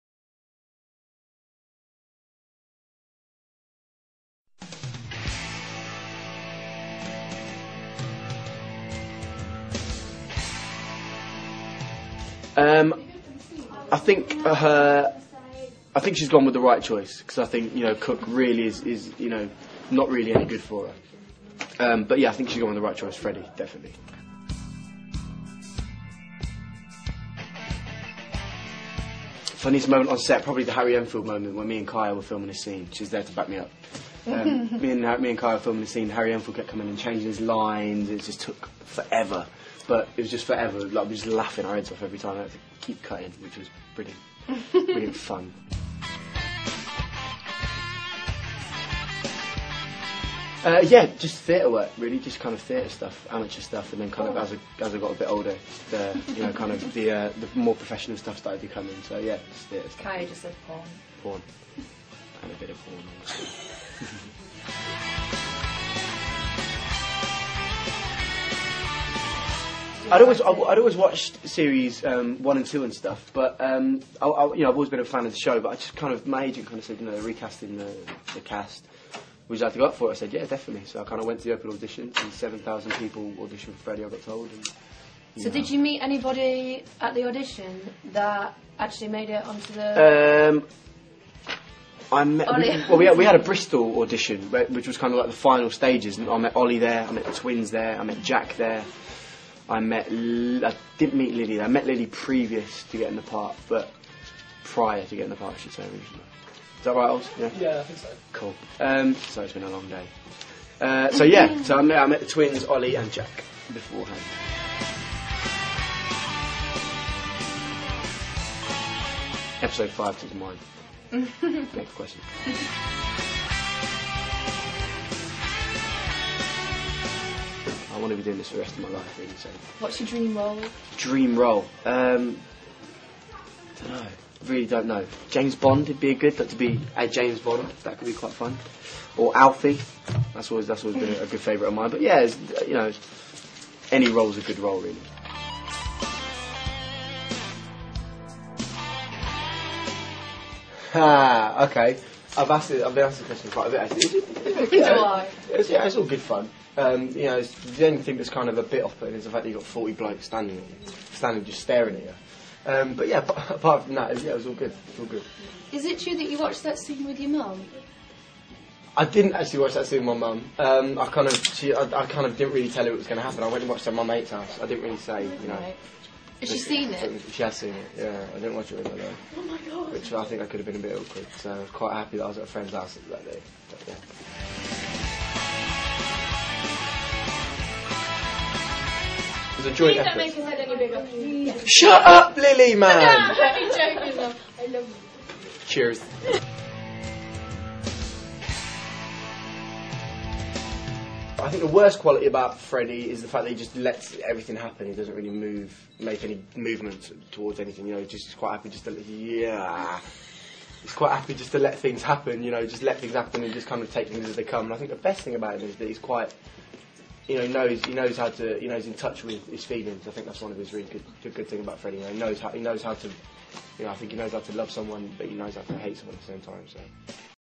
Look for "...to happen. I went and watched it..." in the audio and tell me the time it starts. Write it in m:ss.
2:53.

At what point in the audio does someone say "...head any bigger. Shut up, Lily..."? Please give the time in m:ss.
3:10.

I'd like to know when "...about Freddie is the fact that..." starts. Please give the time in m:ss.
3:22.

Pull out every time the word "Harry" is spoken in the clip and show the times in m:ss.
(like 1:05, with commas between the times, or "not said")
0:30, 0:36.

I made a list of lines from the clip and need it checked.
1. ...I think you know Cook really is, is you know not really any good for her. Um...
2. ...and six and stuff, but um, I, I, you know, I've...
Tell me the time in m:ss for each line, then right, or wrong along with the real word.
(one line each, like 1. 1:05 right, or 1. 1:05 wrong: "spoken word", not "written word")
1. 0:17 right
2. 1:12 wrong: "two", not "six".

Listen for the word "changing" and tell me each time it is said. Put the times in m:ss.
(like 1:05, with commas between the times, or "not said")
0:36.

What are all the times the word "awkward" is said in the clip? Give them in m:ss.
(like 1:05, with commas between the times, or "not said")
3:00.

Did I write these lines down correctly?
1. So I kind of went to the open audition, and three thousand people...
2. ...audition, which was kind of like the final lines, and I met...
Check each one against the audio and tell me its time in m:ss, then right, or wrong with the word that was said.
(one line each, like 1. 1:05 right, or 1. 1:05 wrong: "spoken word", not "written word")
1. 1:20 wrong: "seven", not "three"
2. 1:34 wrong: "stages", not "lines".